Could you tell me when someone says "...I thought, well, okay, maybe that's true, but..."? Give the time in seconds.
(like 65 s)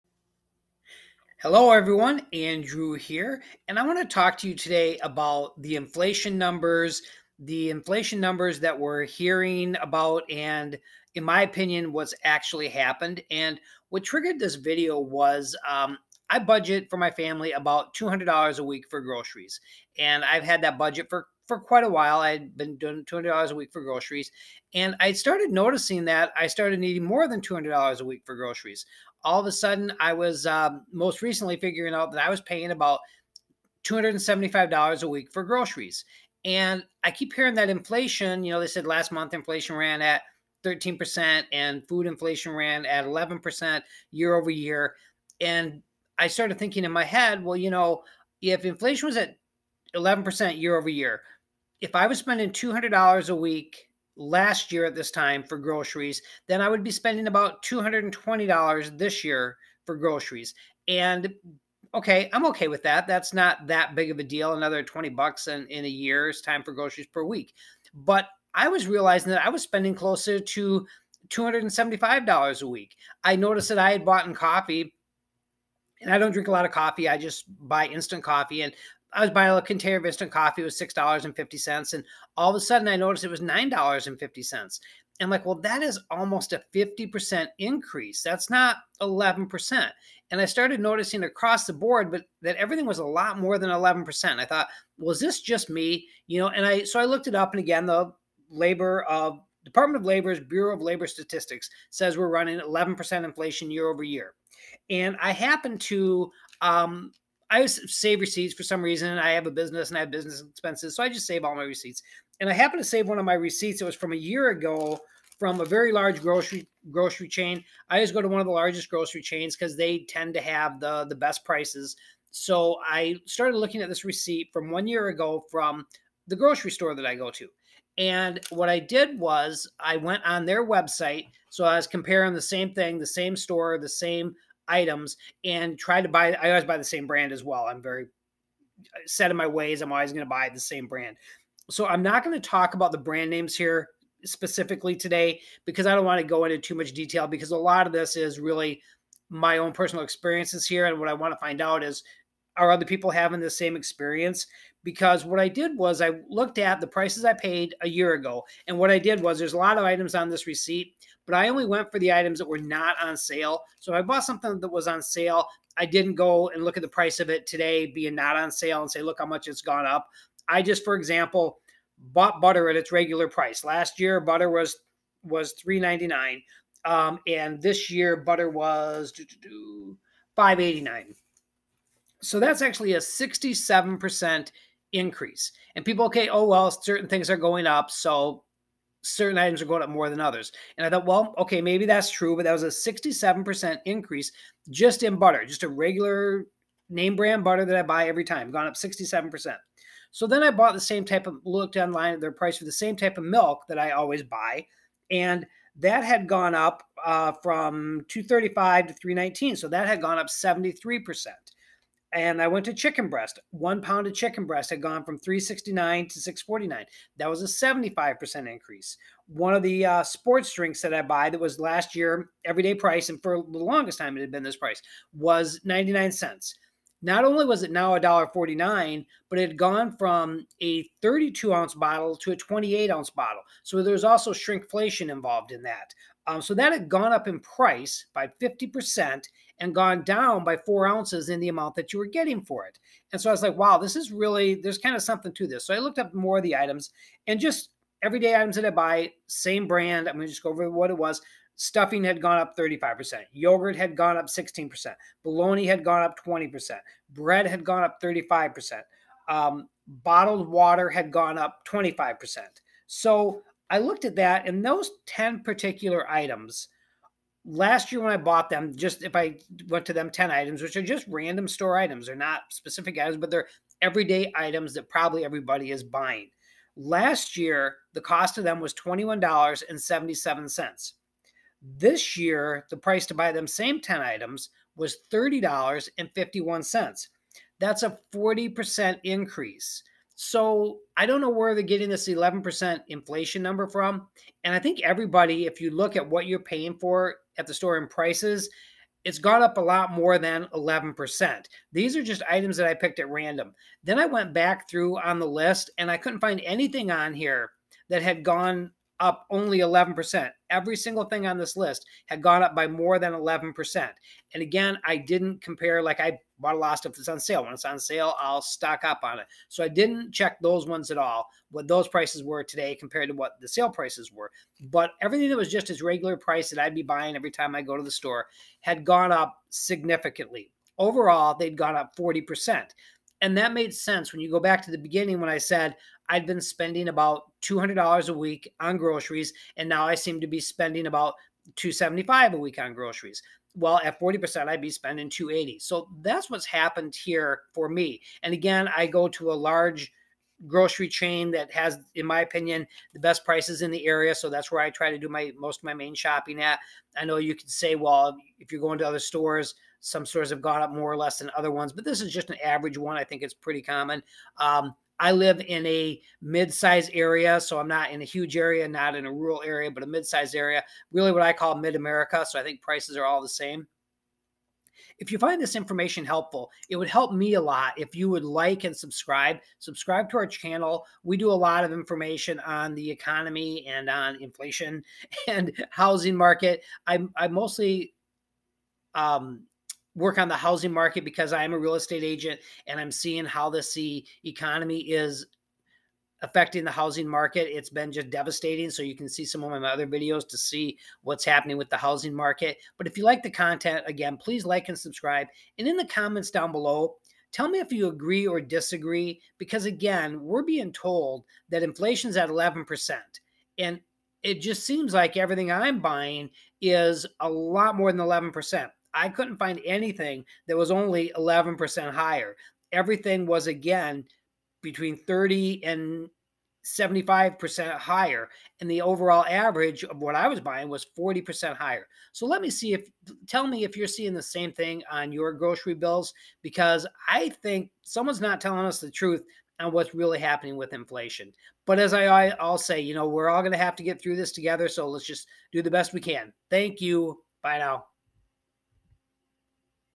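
190 s.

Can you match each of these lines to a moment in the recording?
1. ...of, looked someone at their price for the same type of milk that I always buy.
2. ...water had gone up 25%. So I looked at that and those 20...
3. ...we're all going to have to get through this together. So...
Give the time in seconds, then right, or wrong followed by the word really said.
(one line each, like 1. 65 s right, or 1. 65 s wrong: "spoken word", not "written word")
1. 201 s wrong: "online", not "someone"
2. 260 s wrong: "10", not "20"
3. 443 s right.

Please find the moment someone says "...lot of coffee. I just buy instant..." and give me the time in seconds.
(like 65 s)
76 s.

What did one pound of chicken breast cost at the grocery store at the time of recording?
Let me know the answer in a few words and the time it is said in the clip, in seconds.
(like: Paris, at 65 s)
$6.49, at 216 s.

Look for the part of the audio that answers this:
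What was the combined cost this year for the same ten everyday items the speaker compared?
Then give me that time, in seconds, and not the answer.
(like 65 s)
285 s.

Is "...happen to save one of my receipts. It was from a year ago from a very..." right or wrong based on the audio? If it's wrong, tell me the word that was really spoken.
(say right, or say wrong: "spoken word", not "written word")
right.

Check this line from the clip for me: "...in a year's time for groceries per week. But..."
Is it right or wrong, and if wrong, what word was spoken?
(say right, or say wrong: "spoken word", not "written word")
right.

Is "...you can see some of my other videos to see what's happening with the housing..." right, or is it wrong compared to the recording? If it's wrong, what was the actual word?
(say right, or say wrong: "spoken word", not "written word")
right.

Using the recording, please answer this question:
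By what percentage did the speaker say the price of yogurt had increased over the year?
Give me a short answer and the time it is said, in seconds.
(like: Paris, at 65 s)
16%, at 254 s.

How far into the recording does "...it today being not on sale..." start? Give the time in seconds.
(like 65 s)
167 s.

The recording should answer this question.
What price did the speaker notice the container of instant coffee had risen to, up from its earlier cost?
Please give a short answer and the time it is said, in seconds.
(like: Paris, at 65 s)
$9.50, at 83 s.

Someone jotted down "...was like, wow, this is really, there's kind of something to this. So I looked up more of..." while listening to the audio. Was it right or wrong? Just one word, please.
right.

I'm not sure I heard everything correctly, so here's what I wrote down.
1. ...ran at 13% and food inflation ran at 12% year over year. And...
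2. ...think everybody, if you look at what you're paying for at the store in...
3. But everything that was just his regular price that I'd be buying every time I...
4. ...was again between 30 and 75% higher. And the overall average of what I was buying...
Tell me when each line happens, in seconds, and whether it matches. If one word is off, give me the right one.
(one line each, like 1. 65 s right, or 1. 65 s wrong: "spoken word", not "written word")
1. 39 s wrong: "11", not "12"
2. 294 s right
3. 324 s right
4. 423 s right.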